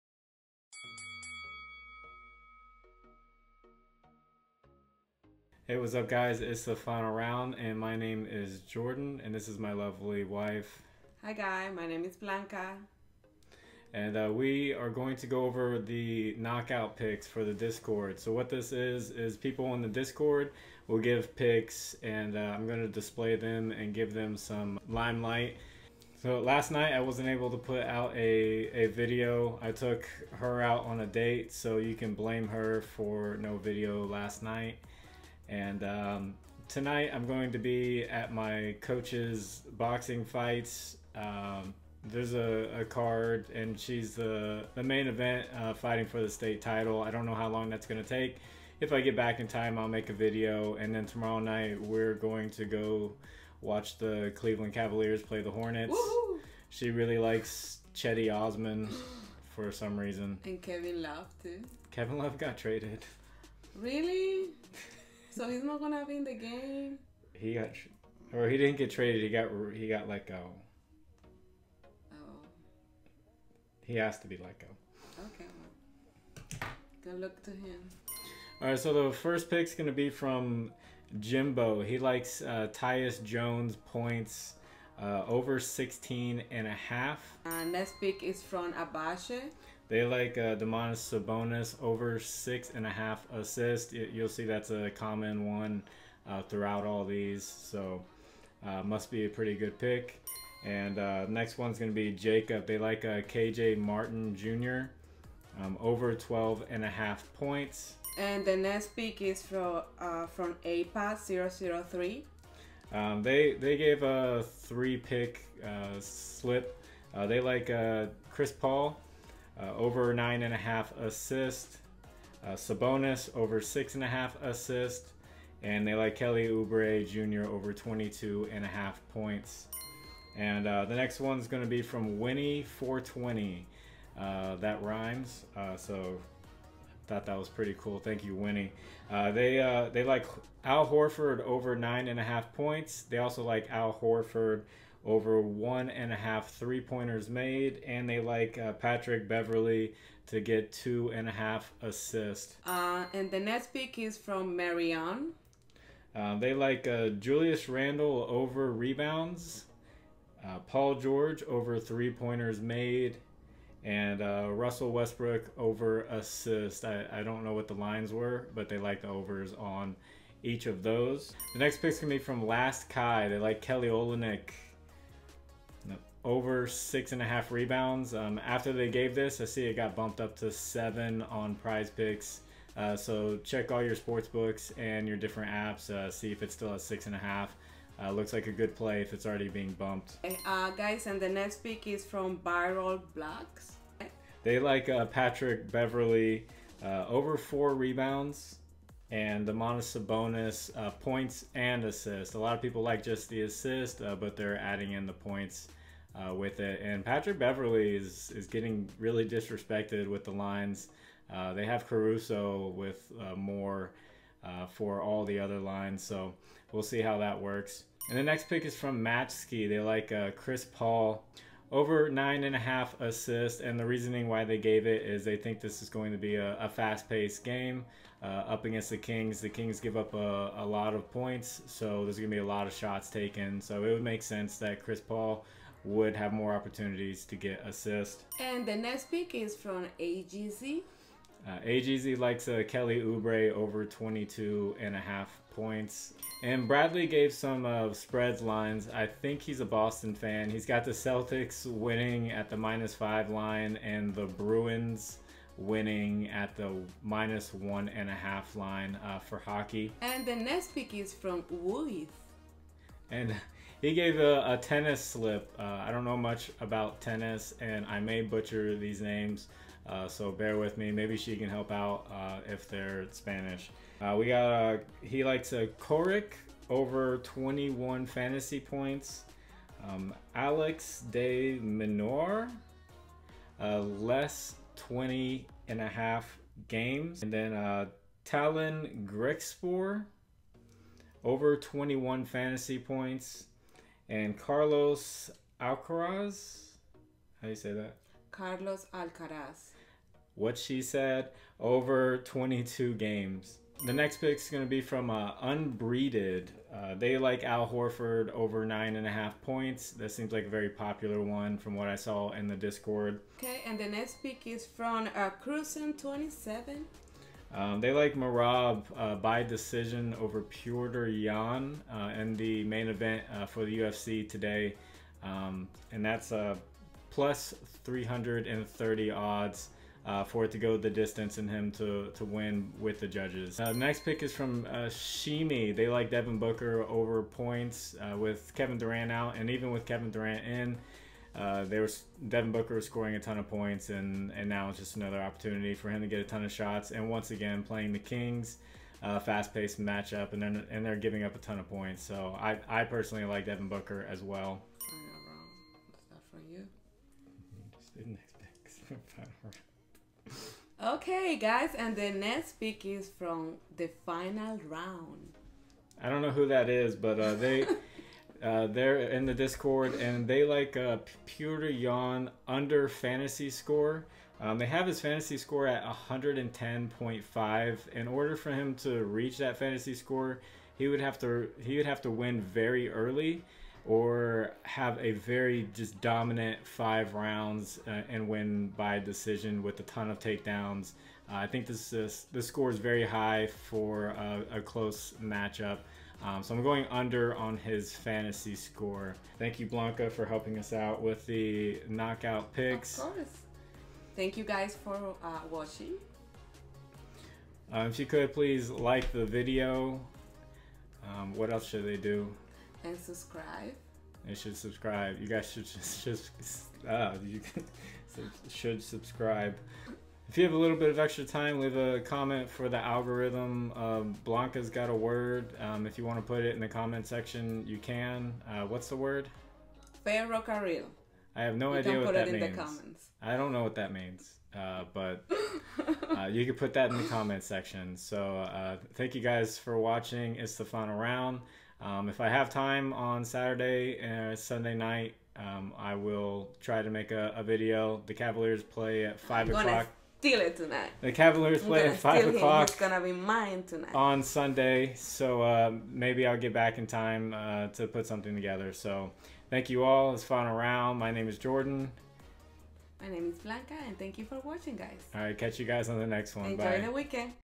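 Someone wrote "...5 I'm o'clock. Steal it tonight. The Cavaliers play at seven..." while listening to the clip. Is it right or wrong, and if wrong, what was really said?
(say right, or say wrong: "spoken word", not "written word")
wrong: "five", not "seven".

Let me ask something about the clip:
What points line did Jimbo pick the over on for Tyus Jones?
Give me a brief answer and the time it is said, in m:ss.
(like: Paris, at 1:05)
16.5, at 1:25.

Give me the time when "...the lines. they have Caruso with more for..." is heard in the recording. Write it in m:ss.
3:30.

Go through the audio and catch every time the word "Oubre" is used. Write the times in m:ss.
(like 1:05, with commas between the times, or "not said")
2:06, 4:02.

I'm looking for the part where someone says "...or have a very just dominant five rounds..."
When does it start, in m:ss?
6:23.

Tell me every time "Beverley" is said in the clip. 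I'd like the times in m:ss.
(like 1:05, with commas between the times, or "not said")
2:29, 3:15, 3:27.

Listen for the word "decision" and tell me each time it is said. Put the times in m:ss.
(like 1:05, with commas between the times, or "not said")
5:19, 6:28.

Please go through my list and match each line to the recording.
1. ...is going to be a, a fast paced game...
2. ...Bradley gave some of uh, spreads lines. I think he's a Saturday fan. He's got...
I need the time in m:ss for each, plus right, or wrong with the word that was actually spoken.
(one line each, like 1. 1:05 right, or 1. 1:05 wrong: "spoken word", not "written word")
1. 3:45 right
2. 4:06 wrong: "Boston", not "Saturday".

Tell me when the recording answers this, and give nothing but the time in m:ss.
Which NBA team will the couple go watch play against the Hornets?
0:54.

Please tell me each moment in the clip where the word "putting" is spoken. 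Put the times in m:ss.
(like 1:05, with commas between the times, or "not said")
not said.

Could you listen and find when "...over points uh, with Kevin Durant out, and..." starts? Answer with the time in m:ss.
5:36.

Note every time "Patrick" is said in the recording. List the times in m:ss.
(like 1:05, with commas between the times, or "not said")
2:28, 3:15, 3:27.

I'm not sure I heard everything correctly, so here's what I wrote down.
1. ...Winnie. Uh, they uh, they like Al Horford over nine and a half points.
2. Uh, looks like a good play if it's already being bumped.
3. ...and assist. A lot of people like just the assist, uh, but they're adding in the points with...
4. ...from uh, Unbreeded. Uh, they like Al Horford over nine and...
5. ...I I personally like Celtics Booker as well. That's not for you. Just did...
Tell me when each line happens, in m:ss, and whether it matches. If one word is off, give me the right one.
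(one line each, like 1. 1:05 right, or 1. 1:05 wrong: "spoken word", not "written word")
1. 2:18 right
2. 3:08 right
3. 3:21 right
4. 5:04 right
5. 5:52 wrong: "Devin", not "Celtics".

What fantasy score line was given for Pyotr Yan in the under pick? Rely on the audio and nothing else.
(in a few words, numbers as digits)
110.5.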